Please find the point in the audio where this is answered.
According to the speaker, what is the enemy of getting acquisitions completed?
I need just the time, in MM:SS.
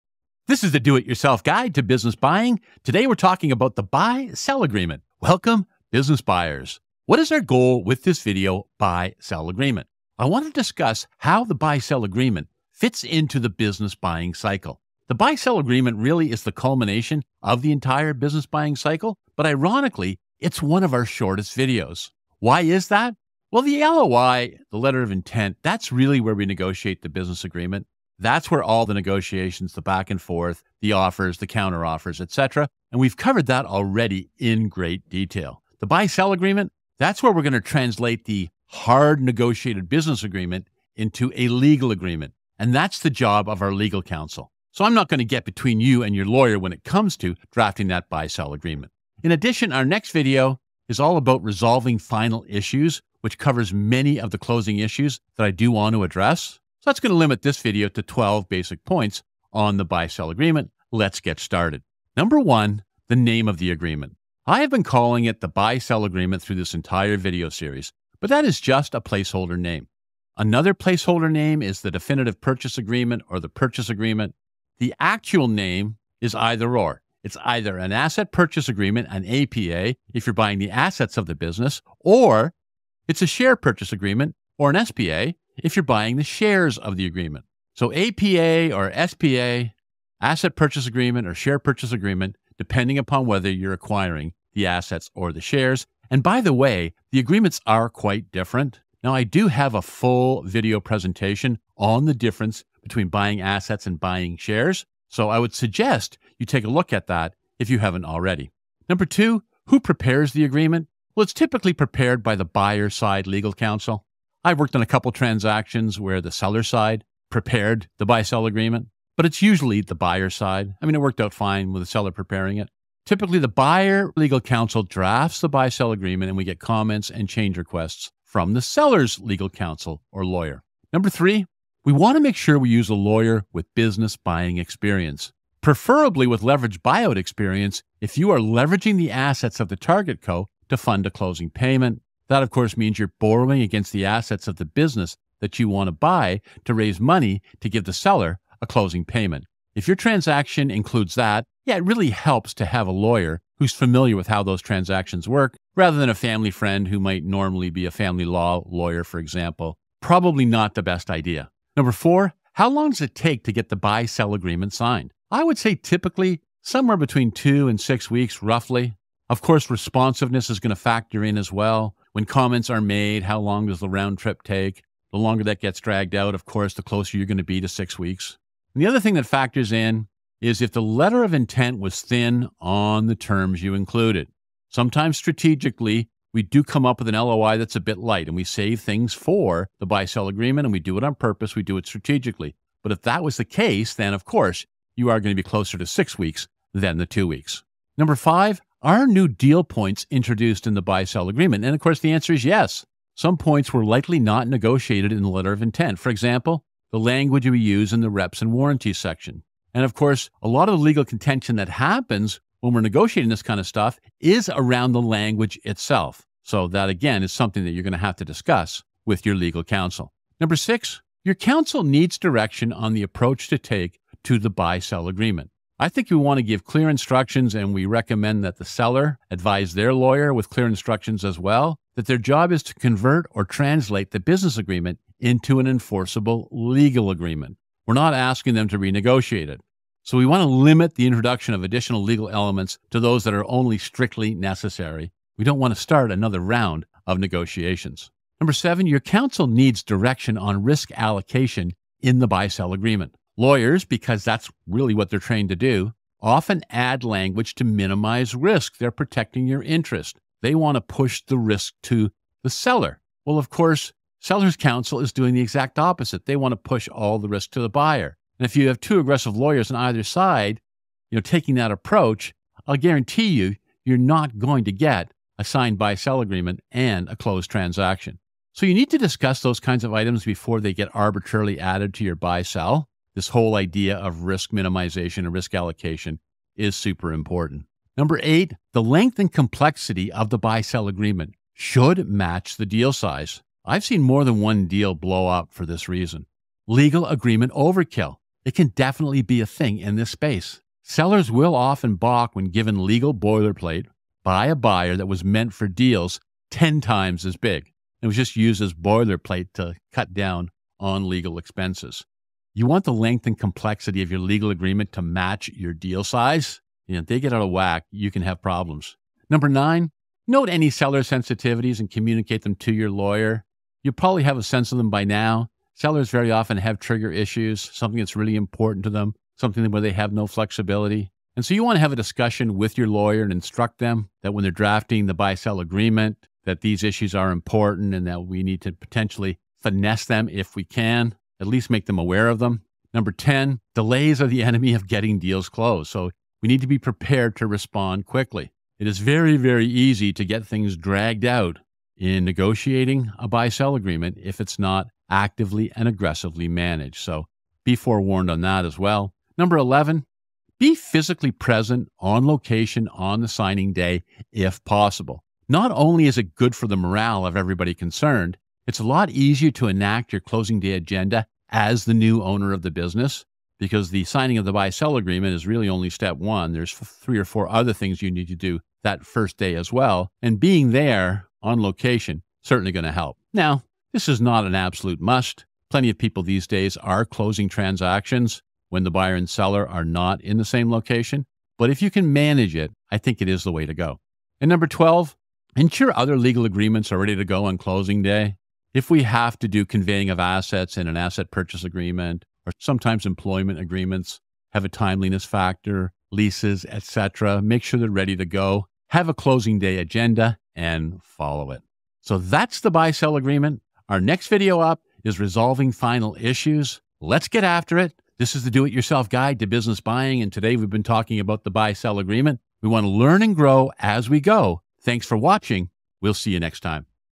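05:43.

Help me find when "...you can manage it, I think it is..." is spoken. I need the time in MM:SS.
06:31.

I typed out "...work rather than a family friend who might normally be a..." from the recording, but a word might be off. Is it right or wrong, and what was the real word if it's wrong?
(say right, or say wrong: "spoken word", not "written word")
right.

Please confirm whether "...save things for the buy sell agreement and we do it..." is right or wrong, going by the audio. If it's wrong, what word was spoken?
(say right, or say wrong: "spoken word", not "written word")
right.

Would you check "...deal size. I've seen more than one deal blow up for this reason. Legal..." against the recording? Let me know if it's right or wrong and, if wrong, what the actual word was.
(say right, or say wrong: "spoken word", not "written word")
right.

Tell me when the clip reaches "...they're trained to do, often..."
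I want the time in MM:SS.
04:15.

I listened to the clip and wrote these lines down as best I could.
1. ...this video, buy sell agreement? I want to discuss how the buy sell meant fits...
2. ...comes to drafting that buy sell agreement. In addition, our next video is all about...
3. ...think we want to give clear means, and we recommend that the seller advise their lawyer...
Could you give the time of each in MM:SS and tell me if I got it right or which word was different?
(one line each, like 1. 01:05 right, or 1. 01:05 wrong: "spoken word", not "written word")
1. 00:08 wrong: "agreement", not "meant"
2. 00:46 right
3. 03:45 wrong: "instructions", not "means".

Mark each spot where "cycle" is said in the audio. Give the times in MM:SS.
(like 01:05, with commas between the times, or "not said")
00:14, 00:18.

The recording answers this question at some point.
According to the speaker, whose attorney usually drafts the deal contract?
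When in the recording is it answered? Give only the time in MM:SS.
01:52.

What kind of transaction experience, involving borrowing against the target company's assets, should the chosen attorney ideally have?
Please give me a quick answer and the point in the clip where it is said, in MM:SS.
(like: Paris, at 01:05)
leverage buyout, at 02:16.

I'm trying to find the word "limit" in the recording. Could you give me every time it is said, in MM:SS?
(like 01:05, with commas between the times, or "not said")
00:57, 04:00.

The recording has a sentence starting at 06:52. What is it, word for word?
So that's the buy sell agreement.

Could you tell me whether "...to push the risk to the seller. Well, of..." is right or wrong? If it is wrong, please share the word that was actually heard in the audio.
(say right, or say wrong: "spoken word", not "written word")
right.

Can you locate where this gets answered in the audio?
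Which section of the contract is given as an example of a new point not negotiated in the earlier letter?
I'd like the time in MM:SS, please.
03:28.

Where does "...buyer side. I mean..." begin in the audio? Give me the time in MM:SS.
01:59.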